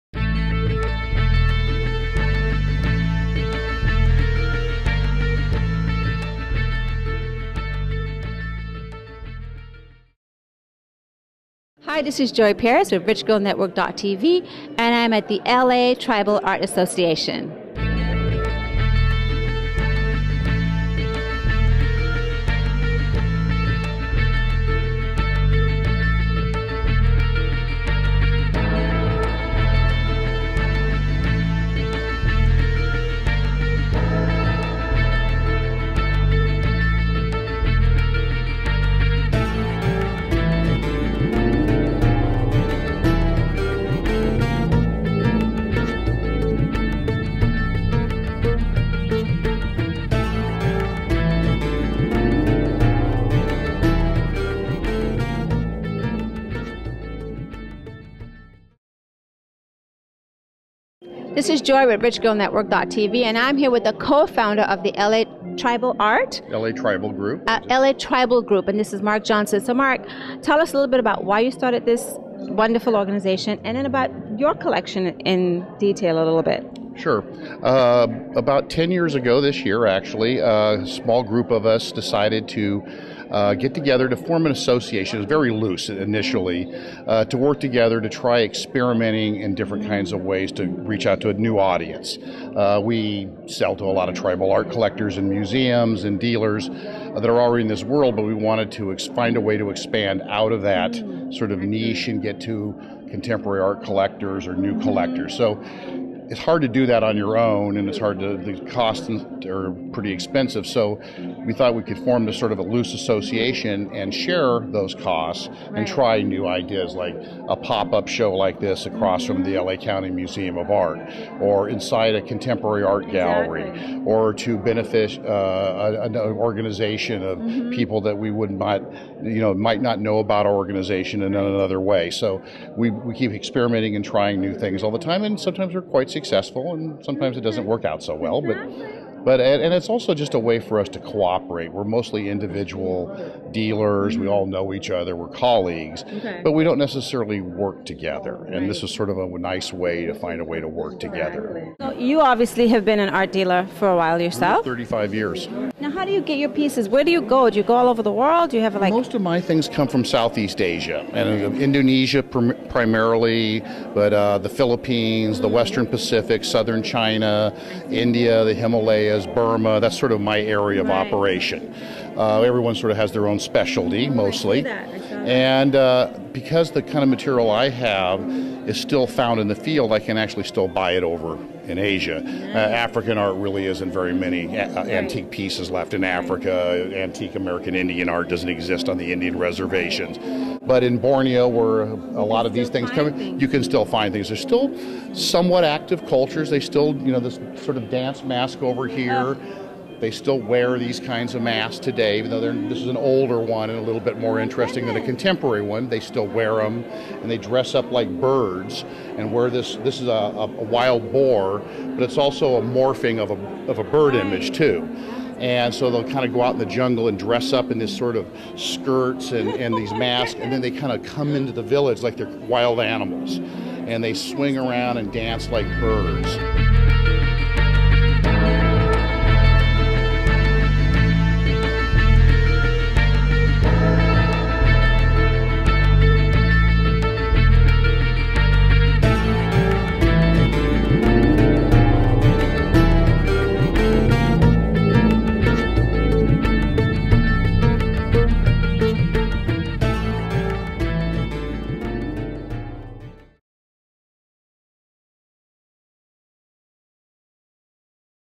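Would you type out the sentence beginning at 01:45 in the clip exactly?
So it's hard to do that on your own, and it's hard to, the costs are pretty expensive.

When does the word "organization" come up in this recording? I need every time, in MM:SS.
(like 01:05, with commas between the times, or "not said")
01:12, 02:06, 02:10.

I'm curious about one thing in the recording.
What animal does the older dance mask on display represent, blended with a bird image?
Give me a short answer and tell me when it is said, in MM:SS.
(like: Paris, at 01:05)
wild boar, at 03:30.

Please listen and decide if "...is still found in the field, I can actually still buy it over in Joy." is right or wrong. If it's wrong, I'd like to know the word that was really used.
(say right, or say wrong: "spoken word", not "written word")
wrong: "Asia", not "Joy".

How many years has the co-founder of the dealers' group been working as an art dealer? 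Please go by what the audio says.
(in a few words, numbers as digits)
35.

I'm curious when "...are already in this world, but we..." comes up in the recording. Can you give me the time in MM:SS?
01:37.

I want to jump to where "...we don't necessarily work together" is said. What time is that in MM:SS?
02:26.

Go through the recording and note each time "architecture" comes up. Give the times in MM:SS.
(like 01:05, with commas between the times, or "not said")
not said.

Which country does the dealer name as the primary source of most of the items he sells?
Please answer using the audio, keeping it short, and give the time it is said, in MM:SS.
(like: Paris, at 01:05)
Indonesia, at 02:41.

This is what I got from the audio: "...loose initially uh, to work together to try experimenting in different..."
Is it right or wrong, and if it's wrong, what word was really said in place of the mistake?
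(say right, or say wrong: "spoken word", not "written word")
right.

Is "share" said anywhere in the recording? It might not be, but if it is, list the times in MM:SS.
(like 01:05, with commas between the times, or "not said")
01:54.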